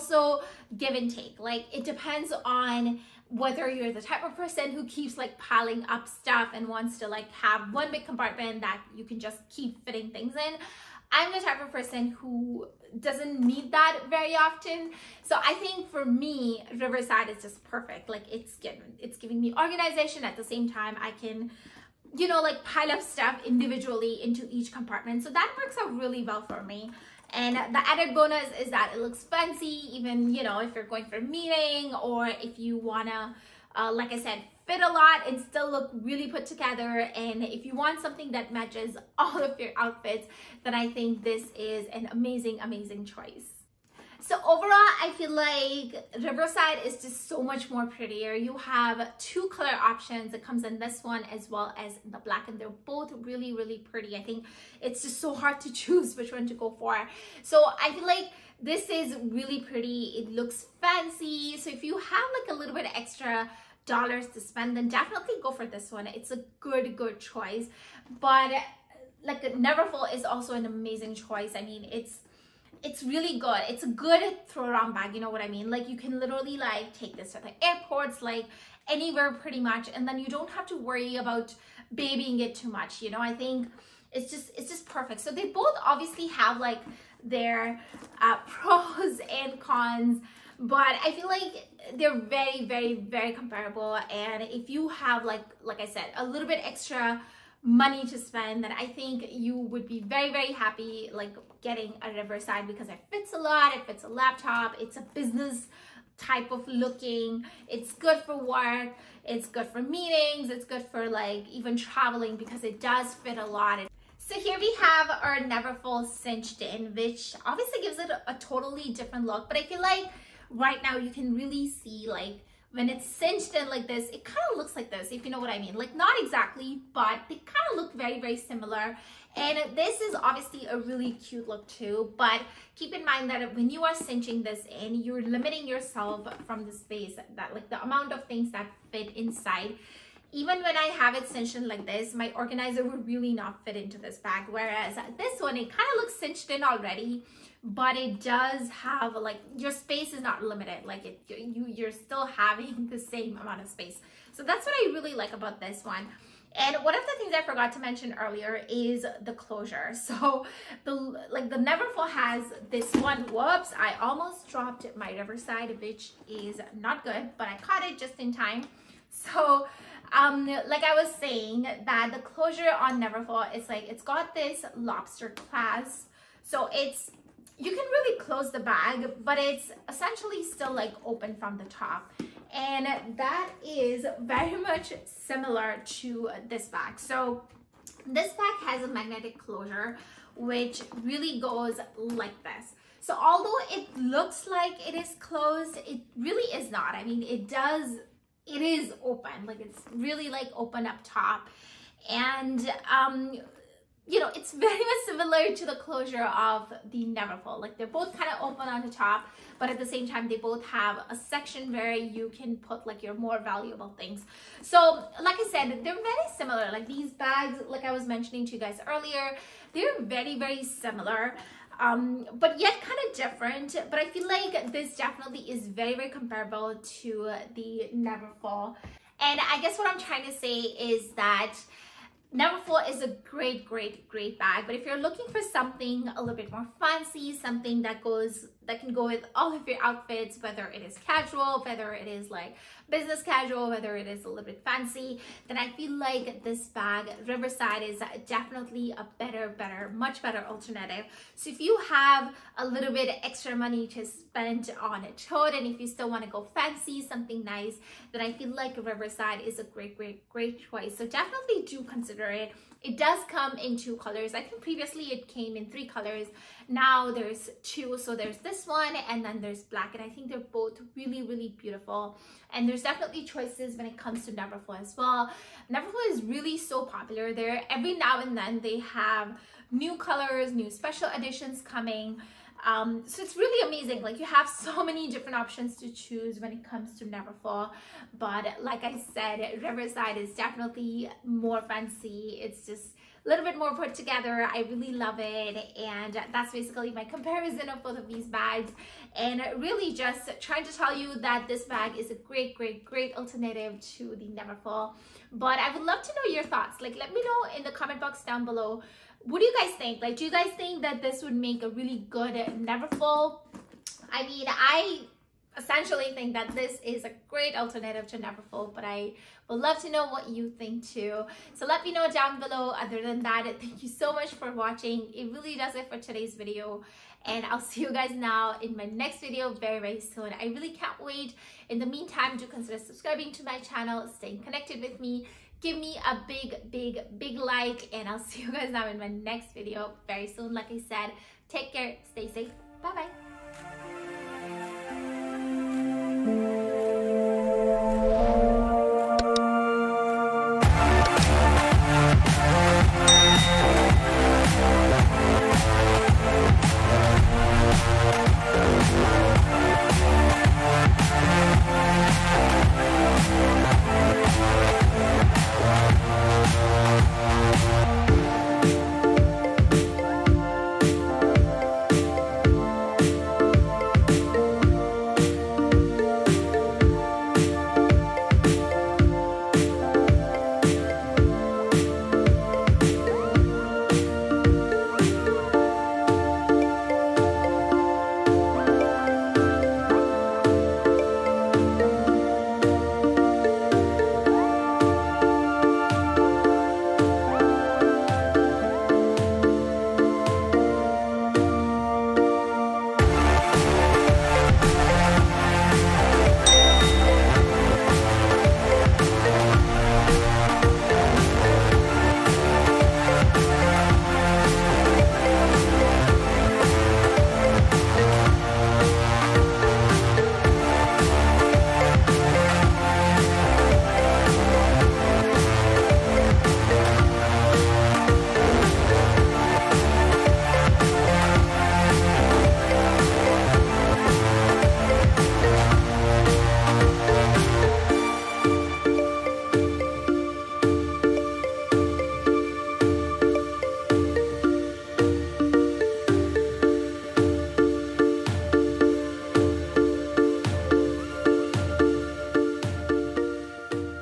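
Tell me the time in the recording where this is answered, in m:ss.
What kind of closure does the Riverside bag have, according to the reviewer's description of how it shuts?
3:08.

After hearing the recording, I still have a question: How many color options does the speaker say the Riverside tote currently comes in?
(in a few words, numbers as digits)
2.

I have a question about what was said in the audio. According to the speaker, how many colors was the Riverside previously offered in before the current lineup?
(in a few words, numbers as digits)
3.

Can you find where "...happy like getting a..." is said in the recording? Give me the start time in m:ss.
1:40.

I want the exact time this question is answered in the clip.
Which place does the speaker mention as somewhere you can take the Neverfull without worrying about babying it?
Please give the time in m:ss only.
1:16.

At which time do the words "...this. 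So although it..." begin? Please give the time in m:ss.
3:12.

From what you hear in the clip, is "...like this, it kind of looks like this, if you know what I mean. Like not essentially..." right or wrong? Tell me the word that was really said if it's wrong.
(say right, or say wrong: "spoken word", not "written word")
wrong: "exactly", not "essentially".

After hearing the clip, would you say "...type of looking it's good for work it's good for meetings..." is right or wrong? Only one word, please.
right.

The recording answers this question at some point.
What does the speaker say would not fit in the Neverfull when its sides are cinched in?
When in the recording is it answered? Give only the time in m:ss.
2:22.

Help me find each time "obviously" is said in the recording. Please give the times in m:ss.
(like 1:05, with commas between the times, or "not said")
1:25, 1:57, 2:10.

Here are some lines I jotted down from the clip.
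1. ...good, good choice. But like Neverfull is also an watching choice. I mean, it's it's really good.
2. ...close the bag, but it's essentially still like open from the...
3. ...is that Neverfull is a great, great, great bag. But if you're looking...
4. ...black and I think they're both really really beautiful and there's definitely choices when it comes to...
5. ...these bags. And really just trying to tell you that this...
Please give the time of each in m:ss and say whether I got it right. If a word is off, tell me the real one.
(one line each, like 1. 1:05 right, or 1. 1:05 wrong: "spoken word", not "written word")
1. 1:06 wrong: "amazing", not "watching"
2. 2:58 right
3. 3:50 right
4. 4:29 right
5. 4:58 right.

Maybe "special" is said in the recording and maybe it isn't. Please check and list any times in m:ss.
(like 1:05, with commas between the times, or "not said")
4:40.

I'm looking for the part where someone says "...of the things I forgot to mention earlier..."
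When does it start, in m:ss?
2:36.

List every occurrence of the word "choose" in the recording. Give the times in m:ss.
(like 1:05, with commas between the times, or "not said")
0:55, 4:45.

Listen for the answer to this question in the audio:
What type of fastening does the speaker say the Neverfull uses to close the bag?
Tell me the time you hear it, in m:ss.
2:53.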